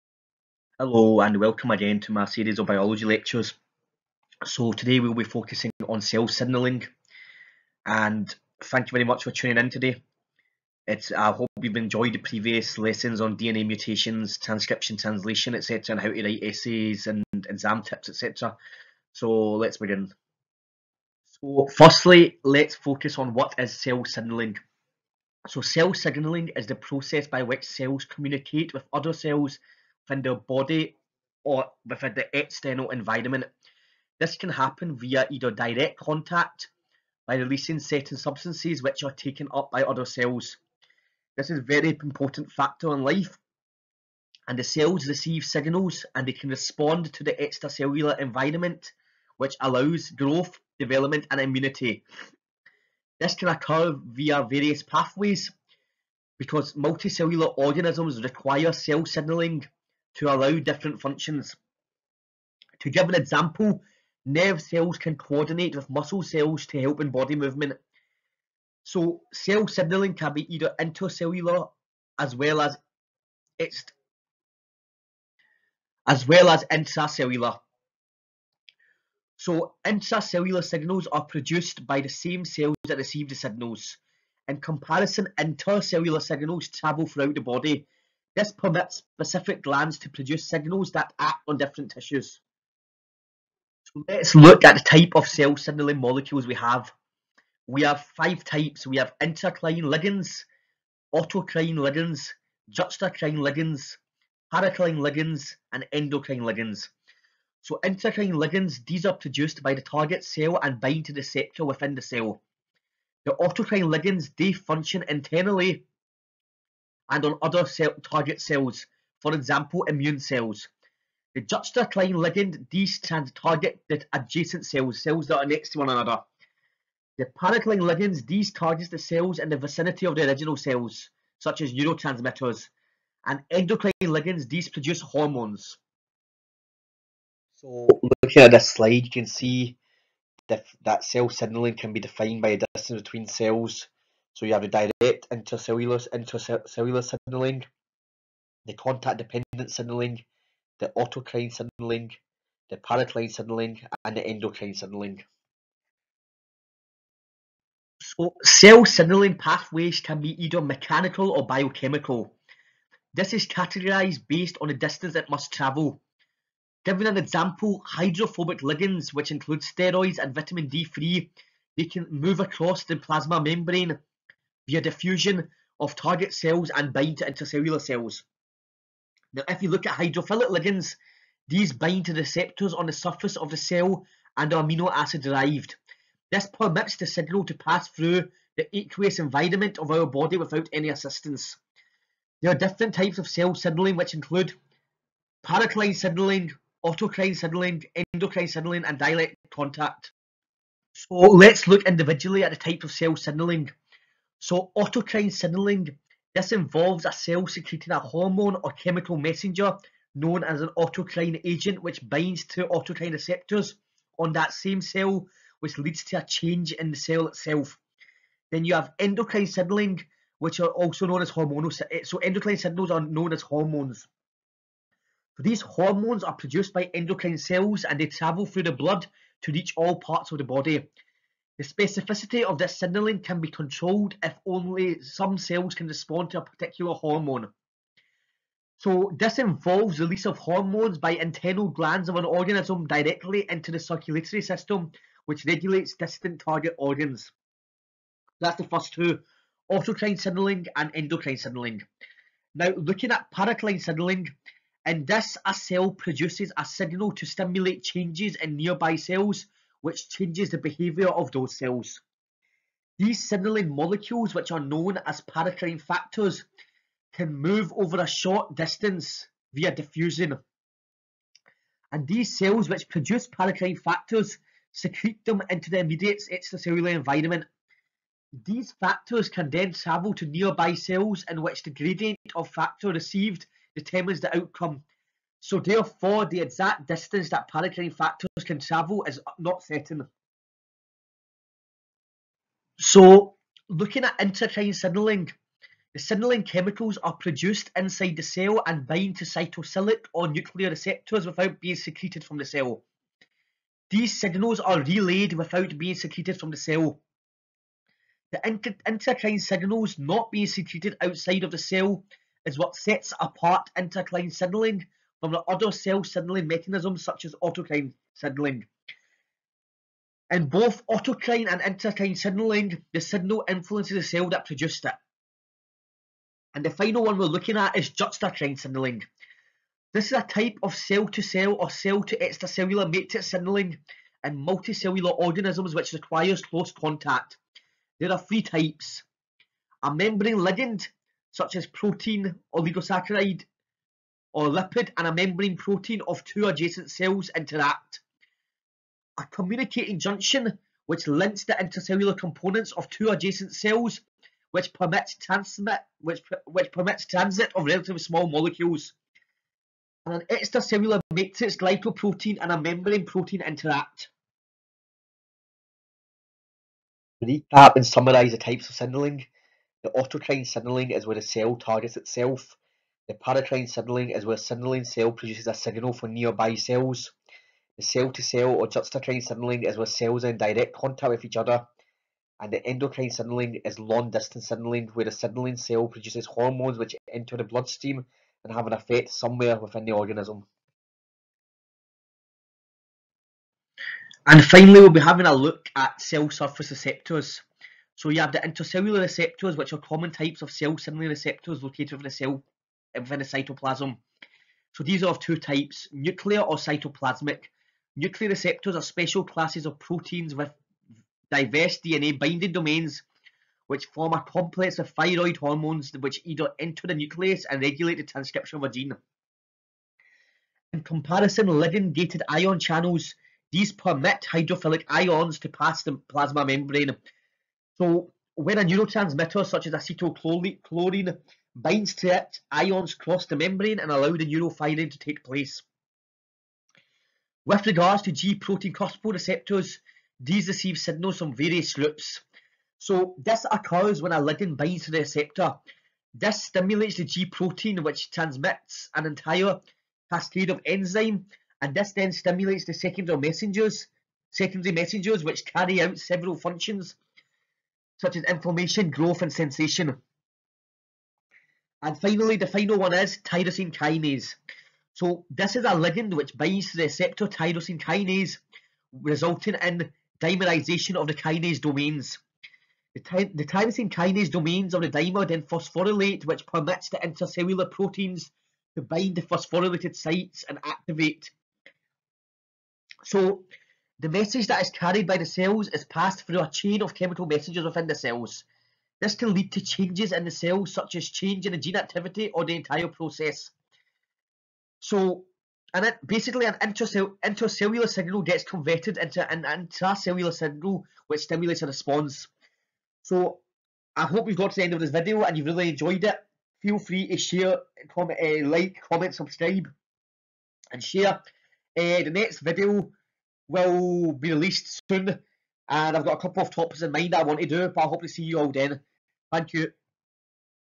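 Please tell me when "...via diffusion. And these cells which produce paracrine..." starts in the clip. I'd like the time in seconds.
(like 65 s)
269 s.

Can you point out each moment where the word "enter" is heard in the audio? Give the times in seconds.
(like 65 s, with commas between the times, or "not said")
387 s, 416 s.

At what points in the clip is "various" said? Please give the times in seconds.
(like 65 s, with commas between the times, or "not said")
54 s, 441 s.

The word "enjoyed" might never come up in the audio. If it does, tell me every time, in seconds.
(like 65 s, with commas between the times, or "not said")
11 s, 505 s.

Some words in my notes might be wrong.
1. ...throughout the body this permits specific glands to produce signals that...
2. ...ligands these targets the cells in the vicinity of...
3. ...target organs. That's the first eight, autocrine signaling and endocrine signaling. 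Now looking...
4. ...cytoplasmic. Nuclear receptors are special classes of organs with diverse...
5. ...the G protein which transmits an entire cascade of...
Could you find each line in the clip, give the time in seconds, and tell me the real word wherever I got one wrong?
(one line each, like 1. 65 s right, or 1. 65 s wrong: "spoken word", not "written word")
1. 87 s right
2. 127 s right
3. 246 s wrong: "two", not "eight"
4. 406 s wrong: "proteins", not "organs"
5. 446 s right.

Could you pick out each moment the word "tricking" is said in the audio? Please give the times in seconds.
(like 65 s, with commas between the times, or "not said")
not said.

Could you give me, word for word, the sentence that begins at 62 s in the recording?
To give an example, nerve cells can coordinate with muscle cells to help in body movement.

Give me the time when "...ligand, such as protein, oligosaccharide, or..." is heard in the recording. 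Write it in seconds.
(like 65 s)
340 s.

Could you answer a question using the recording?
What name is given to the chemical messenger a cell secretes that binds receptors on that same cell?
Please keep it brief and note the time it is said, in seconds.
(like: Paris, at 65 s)
autocrine agent, at 210 s.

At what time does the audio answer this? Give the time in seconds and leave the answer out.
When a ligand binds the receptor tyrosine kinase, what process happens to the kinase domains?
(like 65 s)
470 s.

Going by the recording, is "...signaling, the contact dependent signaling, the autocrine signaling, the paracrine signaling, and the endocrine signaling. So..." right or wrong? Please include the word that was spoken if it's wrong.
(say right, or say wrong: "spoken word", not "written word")
right.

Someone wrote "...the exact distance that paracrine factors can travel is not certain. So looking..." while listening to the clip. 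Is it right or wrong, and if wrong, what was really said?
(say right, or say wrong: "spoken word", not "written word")
right.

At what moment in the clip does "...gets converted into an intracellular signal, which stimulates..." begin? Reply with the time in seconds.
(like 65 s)
498 s.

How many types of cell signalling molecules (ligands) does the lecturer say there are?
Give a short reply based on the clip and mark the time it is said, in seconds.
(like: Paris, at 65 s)
5, at 98 s.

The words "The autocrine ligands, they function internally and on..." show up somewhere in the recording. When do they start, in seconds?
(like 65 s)
113 s.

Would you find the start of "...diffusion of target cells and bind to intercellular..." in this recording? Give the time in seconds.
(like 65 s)
174 s.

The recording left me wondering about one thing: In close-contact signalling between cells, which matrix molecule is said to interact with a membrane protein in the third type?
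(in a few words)
extracellular matrix glycoprotein.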